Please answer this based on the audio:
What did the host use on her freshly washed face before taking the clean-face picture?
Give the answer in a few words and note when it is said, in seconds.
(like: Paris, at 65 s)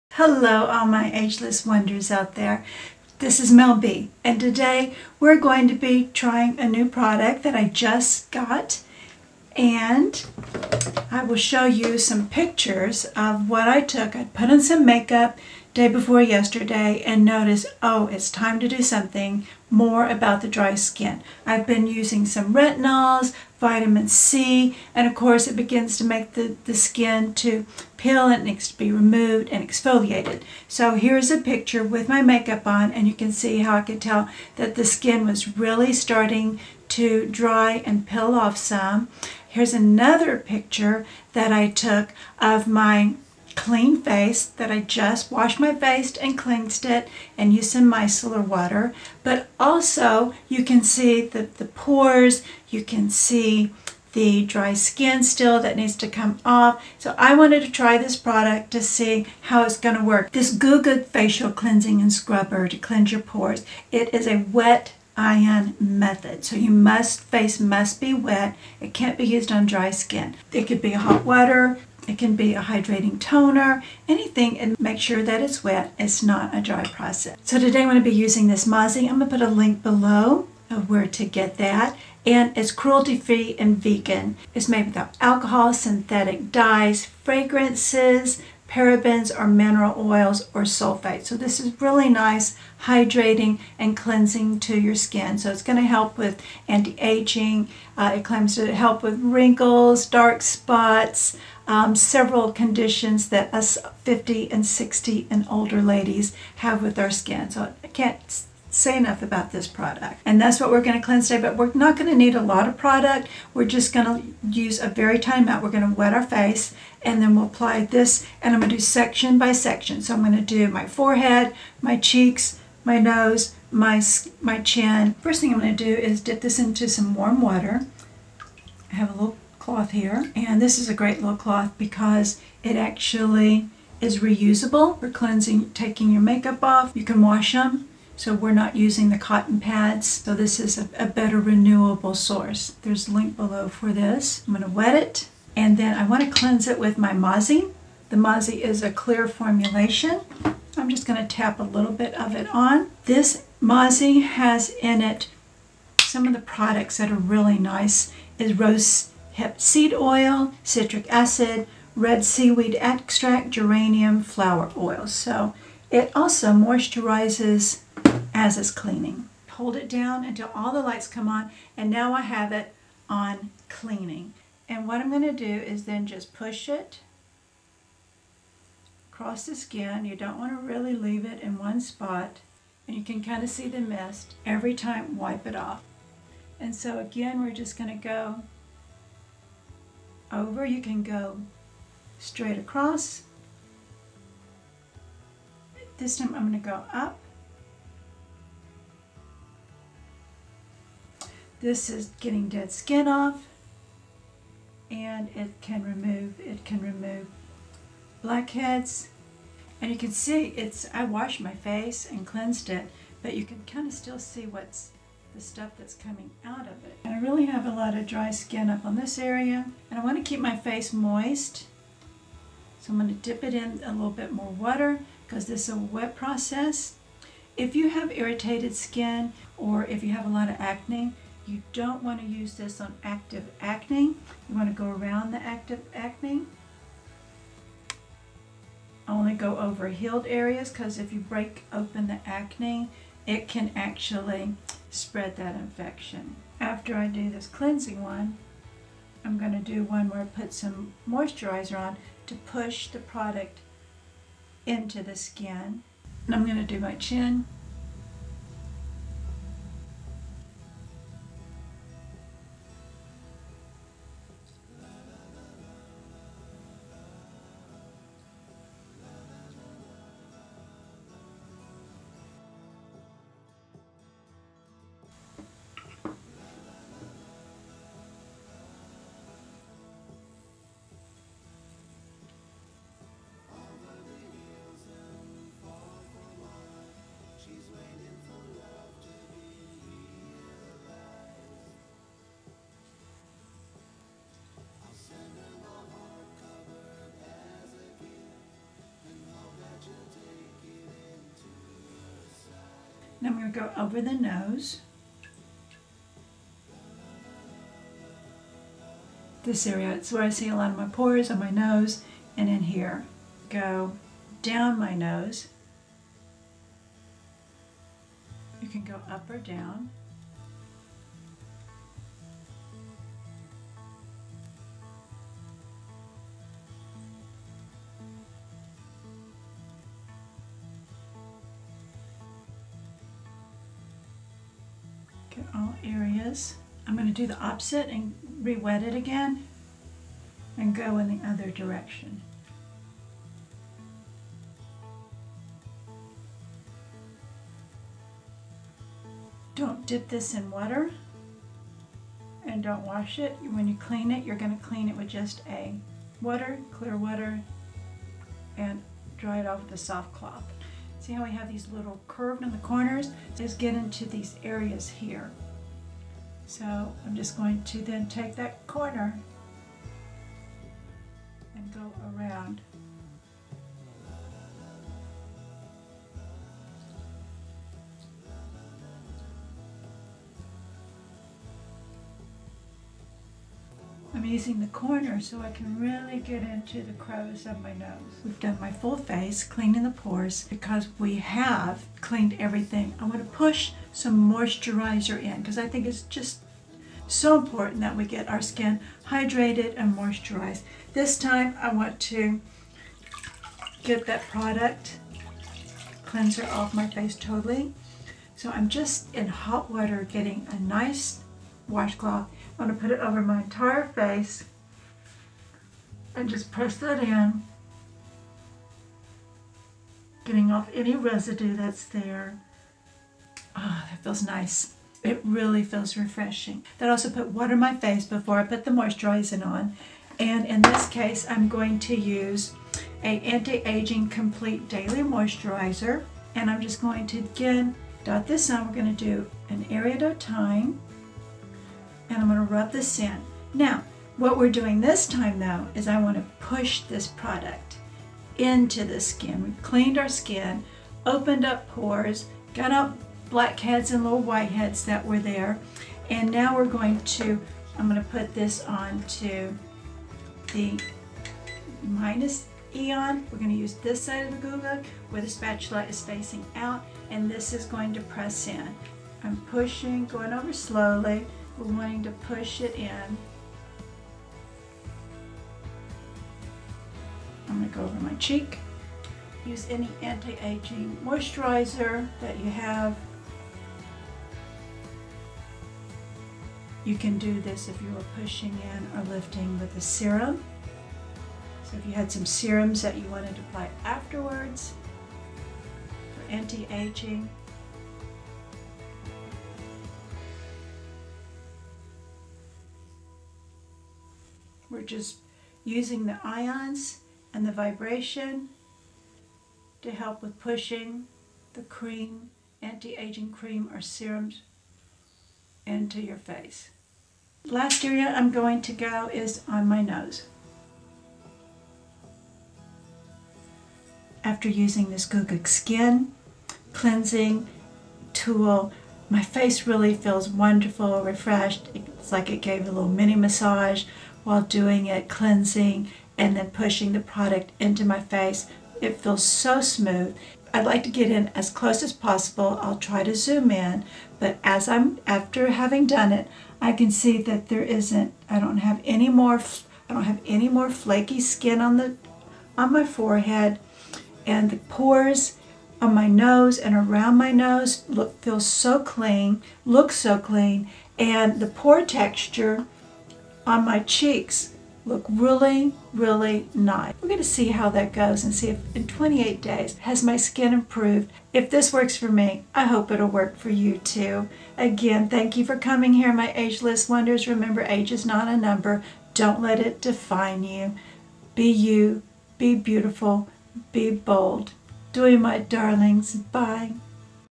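micellar water, at 47 s.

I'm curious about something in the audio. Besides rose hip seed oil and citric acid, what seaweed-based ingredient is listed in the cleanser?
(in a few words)
red seaweed extract.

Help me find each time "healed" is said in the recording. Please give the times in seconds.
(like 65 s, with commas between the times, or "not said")
239 s.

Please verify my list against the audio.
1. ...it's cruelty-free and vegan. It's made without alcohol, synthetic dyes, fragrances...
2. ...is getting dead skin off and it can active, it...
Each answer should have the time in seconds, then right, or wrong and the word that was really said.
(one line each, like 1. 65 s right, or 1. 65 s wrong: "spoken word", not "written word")
1. 82 s right
2. 201 s wrong: "remove", not "active".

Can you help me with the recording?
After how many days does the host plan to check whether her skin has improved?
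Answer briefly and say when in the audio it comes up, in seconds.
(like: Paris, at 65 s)
28, at 568 s.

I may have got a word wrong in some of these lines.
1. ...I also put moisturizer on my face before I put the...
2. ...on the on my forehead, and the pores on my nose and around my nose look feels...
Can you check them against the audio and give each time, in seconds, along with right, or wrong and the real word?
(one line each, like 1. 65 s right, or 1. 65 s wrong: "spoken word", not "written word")
1. 426 s wrong: "water", not "moisturizer"
2. 551 s right.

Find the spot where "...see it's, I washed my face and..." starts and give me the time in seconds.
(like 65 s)
210 s.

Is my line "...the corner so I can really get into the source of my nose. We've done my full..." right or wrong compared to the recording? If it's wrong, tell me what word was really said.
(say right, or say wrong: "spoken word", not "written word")
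wrong: "crevice", not "source".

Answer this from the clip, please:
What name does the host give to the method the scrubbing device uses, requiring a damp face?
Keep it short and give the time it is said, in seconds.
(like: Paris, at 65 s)
wet ion method, at 64 s.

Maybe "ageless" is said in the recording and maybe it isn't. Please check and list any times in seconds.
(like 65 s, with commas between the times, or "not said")
1 s, 576 s.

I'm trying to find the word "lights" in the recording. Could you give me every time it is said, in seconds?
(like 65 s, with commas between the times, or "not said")
170 s.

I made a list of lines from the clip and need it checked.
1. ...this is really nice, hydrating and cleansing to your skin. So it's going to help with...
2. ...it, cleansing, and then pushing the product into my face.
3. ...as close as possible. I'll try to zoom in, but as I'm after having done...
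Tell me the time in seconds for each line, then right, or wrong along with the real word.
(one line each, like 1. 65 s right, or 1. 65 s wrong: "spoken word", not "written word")
1. 91 s right
2. 534 s right
3. 541 s right.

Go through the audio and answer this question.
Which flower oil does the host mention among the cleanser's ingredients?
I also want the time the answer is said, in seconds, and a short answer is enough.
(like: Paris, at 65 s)
geranium flower oil, at 163 s.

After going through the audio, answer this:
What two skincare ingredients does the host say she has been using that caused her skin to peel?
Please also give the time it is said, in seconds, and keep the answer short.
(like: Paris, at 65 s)
retinols, vitamin C, at 22 s.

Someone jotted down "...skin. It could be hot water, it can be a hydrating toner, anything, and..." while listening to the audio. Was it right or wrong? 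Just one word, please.
right.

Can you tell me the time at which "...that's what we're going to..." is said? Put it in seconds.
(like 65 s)
110 s.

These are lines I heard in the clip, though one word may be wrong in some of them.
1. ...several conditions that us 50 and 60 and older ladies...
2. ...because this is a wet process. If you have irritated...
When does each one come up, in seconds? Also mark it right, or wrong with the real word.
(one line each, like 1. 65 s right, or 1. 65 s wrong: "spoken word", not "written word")
1. 101 s right
2. 225 s right.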